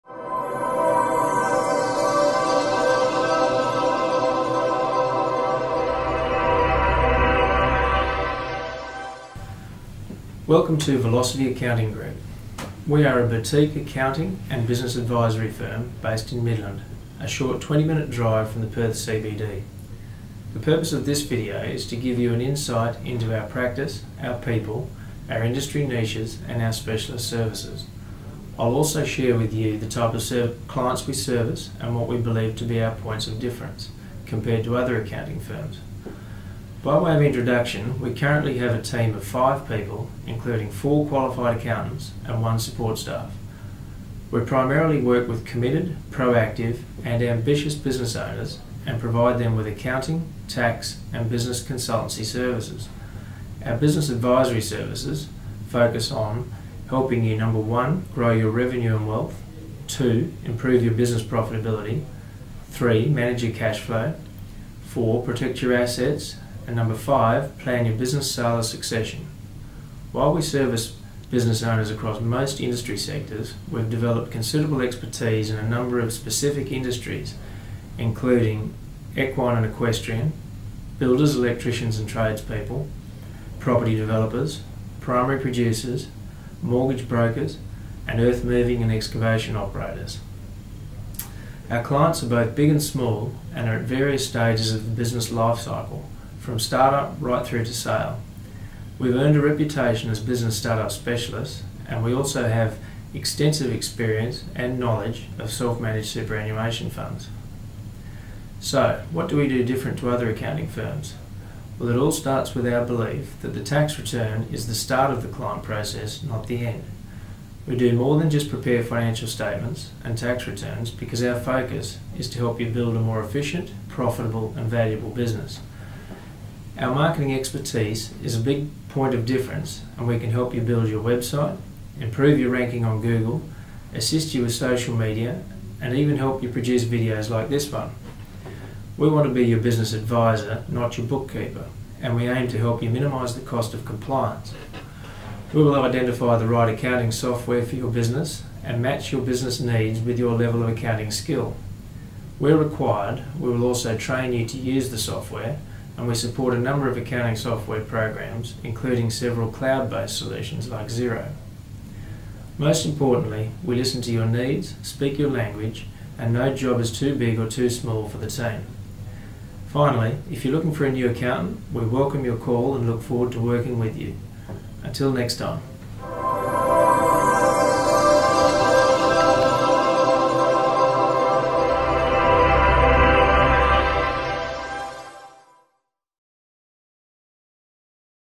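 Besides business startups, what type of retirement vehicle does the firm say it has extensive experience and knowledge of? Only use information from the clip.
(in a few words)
Self managed superannuation funds.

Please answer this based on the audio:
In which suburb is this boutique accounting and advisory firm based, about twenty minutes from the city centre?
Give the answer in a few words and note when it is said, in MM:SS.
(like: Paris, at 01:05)
Midland, at 00:16.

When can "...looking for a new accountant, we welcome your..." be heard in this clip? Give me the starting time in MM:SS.
02:50.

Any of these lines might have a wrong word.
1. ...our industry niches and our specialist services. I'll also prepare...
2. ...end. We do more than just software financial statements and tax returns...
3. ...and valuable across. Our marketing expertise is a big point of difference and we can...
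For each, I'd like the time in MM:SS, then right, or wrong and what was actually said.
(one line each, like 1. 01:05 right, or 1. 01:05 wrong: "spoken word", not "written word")
1. 00:25 wrong: "share", not "prepare"
2. 01:56 wrong: "prepare", not "software"
3. 02:04 wrong: "business", not "across".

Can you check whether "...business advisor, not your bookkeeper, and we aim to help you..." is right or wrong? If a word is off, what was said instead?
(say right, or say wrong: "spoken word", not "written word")
right.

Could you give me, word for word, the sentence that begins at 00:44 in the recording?
We primarily work with committed, proactive, and ambitious business owners and provide them with accounting, tax, and business consultancy services.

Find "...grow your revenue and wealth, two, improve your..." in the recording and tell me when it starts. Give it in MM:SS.
00:58.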